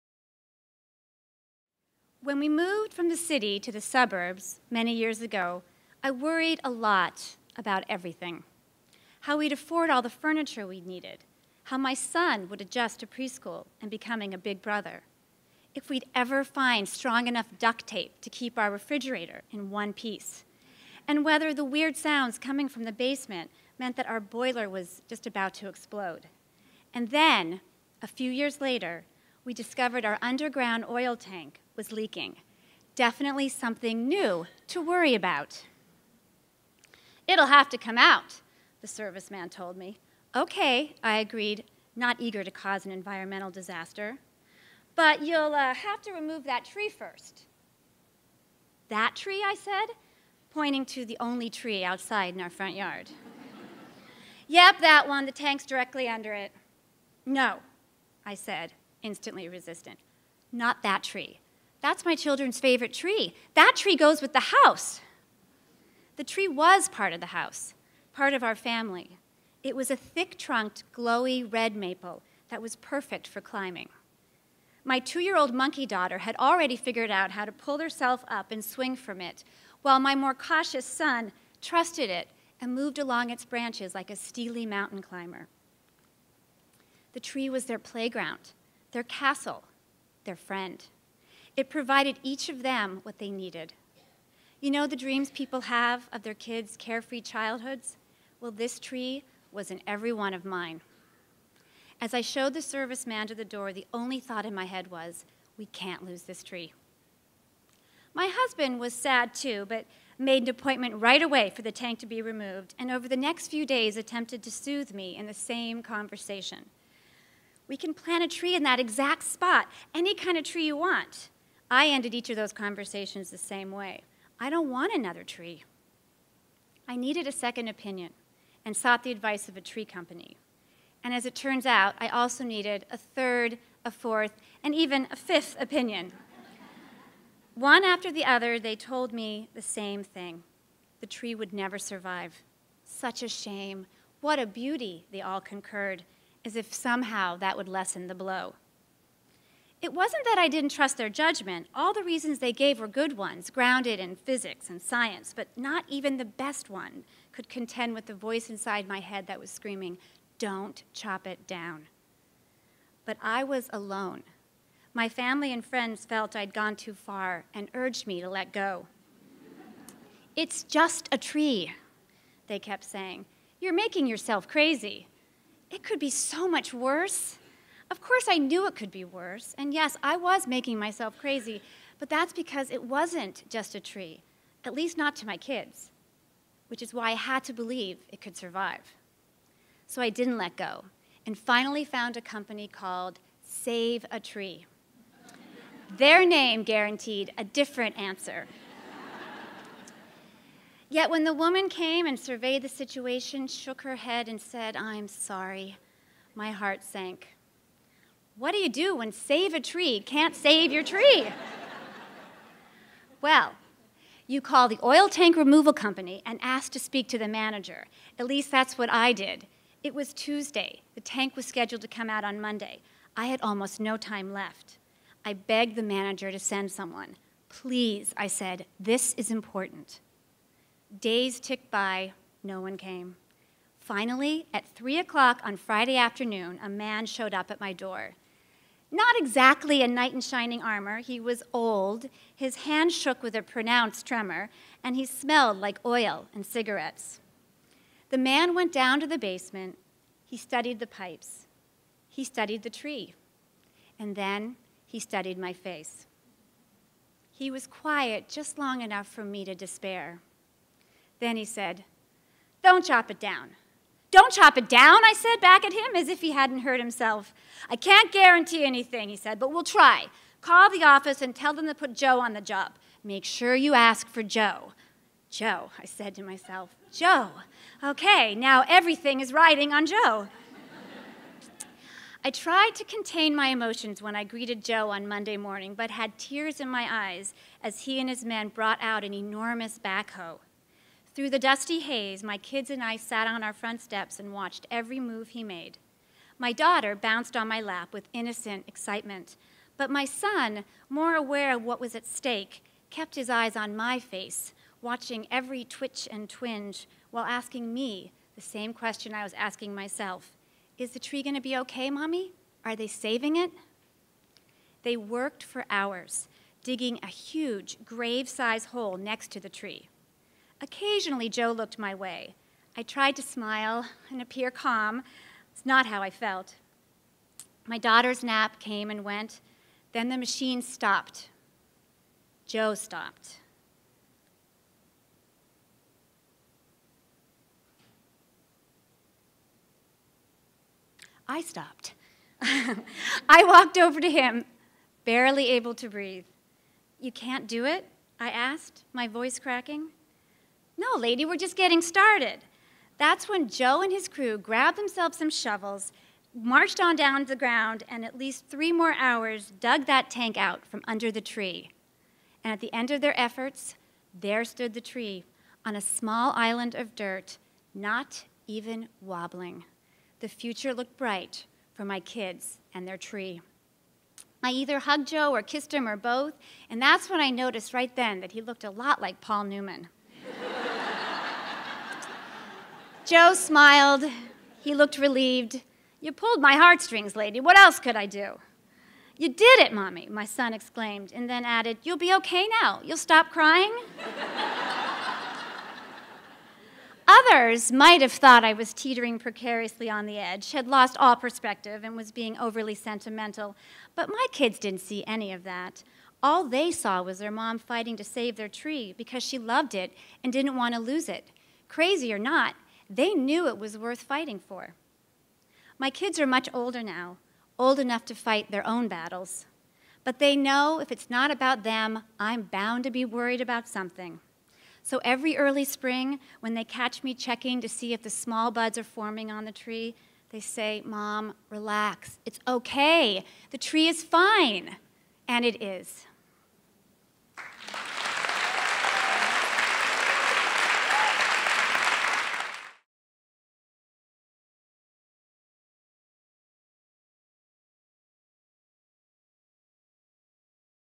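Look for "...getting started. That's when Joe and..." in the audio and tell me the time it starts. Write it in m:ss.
5:51.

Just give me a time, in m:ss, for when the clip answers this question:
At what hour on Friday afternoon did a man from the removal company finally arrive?
3:54.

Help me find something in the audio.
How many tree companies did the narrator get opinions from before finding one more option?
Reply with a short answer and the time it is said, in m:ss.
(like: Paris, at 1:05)
5, at 2:15.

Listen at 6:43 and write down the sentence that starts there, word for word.
But my kids didn't see any of that.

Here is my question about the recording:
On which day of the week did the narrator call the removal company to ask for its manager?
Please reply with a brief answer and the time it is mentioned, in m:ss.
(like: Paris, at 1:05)
Tuesday, at 3:40.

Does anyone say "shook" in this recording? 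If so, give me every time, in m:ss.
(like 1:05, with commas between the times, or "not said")
3:23, 4:02.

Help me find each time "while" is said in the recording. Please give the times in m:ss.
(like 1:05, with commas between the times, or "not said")
1:19, 5:07.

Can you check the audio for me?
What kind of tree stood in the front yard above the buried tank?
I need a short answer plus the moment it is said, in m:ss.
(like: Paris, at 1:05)
red maple, at 1:11.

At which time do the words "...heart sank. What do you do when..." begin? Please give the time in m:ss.
3:26.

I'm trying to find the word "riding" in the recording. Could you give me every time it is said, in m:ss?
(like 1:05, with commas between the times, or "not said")
4:39.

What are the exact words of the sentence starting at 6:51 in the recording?
Crazy or not, they knew it was worth fighting for.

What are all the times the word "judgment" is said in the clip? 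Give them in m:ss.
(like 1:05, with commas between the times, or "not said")
2:31.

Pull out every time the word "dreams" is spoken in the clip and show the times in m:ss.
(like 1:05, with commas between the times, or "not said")
1:34.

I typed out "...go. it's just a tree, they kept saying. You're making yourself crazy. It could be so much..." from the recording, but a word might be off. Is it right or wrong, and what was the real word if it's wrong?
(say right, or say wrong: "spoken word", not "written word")
right.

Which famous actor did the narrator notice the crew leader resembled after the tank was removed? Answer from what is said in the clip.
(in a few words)
Paul Newman.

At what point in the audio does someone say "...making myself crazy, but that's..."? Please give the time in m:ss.
3:00.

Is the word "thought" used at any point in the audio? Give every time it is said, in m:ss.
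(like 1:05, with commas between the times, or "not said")
1:44, 6:38.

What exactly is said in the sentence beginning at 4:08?
The man went down to the basement, he studied the pipes, he studied the tree, and then he studied my face.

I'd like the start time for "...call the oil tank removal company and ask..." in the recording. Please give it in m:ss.
3:34.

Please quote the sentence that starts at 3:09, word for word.
So I didn't let go and finally found a company called Save a Tree.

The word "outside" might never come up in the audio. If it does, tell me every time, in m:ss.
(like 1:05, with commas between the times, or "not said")
0:51.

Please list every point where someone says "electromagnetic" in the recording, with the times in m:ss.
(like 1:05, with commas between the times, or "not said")
not said.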